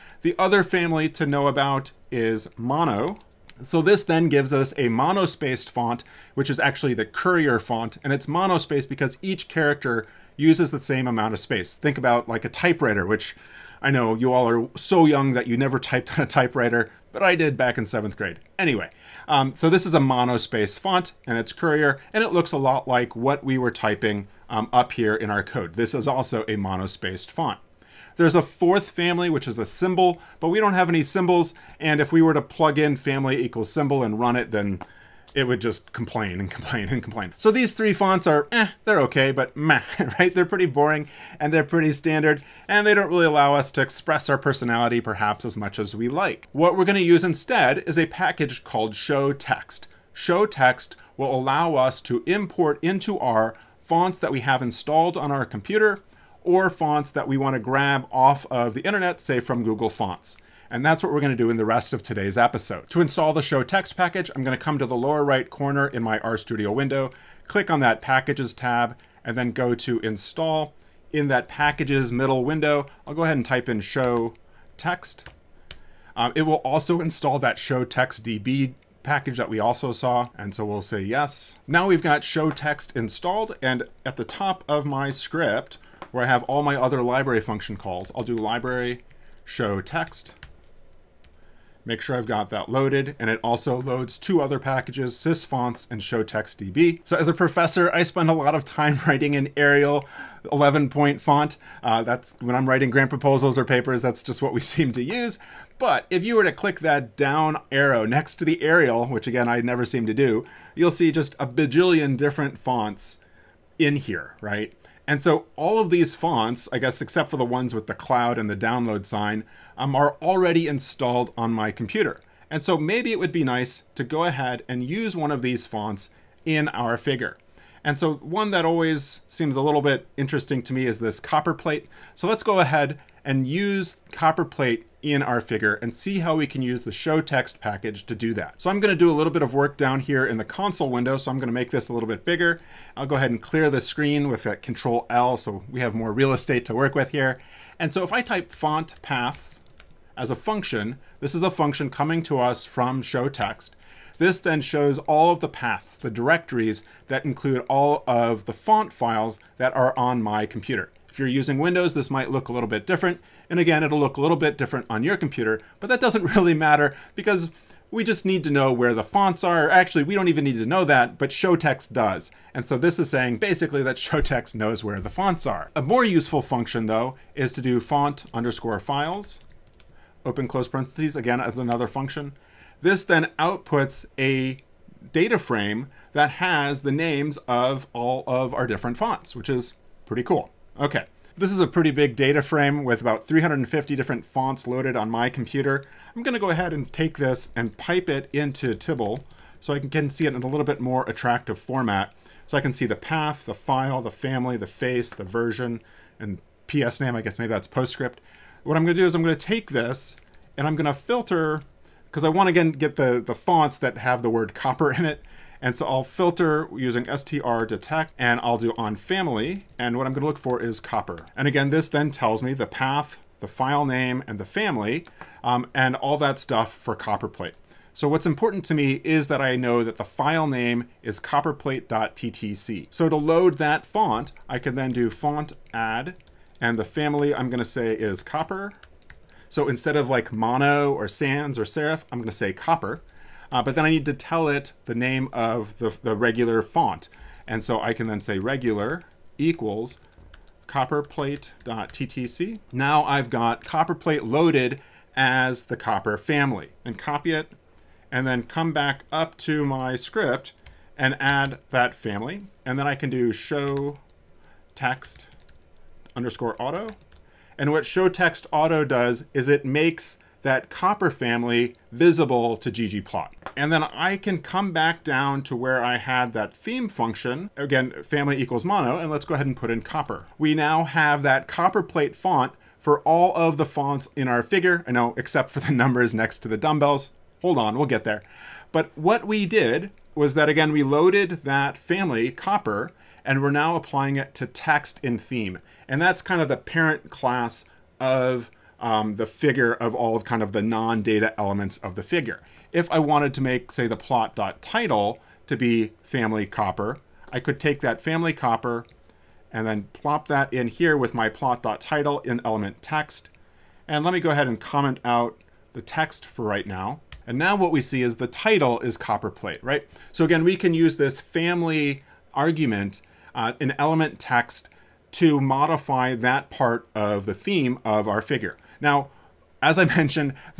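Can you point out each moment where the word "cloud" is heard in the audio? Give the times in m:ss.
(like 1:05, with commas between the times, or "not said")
1:57.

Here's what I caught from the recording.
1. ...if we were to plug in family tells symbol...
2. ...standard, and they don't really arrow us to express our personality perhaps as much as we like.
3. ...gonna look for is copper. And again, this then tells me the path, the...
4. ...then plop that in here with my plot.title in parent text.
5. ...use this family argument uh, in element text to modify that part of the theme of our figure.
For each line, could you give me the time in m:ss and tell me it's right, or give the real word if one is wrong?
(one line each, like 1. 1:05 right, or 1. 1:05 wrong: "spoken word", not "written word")
1. 0:31 wrong: "equals", not "tells"
2. 0:41 wrong: "allow", not "arrow"
3. 3:40 right
4. 5:09 wrong: "element", not "parent"
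5. 5:20 right.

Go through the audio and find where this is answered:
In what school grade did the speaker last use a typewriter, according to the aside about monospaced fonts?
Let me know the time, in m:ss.
0:17.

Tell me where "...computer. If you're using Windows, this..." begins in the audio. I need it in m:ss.
2:40.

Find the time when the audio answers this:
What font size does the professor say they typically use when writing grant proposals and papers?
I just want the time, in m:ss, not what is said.
1:40.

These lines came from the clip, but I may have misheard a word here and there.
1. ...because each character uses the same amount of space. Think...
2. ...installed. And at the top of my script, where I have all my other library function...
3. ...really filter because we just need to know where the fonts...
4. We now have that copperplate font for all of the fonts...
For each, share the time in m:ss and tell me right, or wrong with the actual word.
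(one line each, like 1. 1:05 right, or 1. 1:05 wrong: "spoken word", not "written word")
1. 0:08 right
2. 1:22 right
3. 2:46 wrong: "matter", not "filter"
4. 4:40 right.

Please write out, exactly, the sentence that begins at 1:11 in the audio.
In that packages middle window, I'll go ahead and type in show text.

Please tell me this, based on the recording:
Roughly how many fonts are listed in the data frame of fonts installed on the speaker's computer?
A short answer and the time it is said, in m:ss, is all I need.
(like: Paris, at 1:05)
350, at 3:13.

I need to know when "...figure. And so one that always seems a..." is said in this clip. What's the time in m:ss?
2:06.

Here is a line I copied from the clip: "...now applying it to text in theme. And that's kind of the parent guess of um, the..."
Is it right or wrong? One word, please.
wrong.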